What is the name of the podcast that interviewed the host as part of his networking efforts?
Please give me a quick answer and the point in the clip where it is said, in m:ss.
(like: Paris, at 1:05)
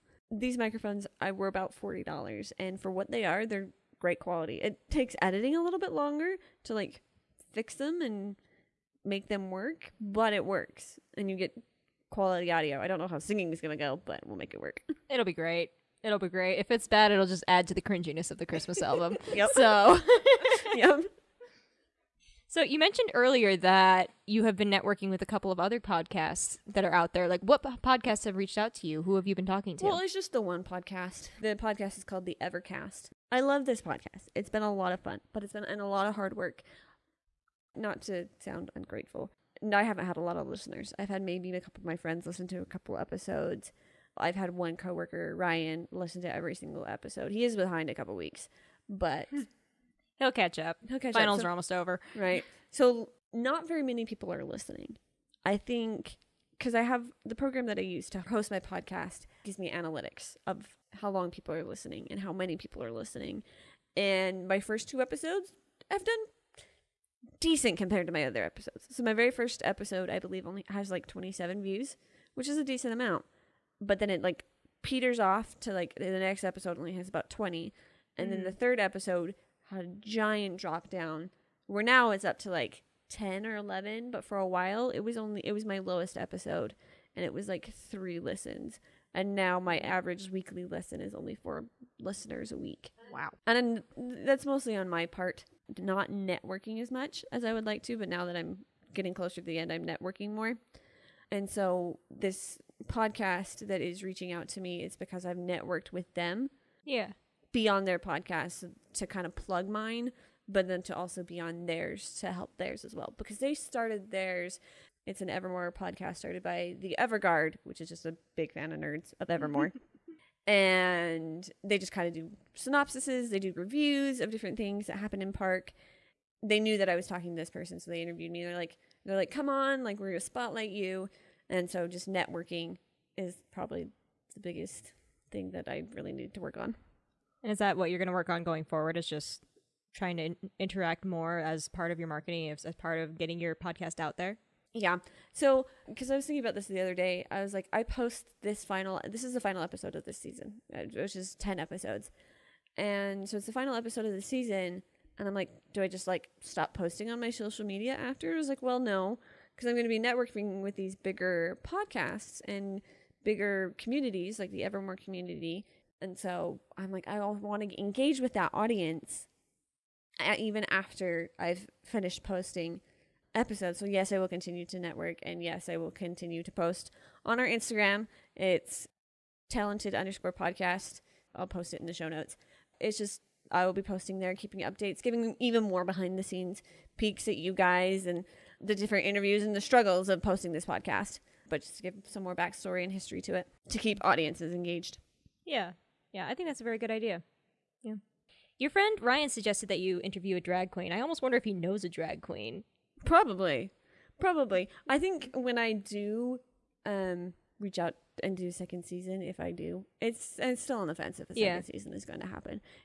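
The Evercast, at 0:32.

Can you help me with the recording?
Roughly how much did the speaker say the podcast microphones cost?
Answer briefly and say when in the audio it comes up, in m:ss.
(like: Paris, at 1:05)
$40, at 0:01.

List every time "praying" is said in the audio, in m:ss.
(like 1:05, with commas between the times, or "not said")
not said.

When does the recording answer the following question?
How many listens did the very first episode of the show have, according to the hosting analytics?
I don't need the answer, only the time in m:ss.
1:11.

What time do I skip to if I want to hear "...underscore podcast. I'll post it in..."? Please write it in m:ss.
2:59.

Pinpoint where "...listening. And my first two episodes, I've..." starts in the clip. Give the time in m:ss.
1:02.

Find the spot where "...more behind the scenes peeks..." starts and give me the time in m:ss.
3:05.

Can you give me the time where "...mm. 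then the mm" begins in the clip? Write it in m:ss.
1:18.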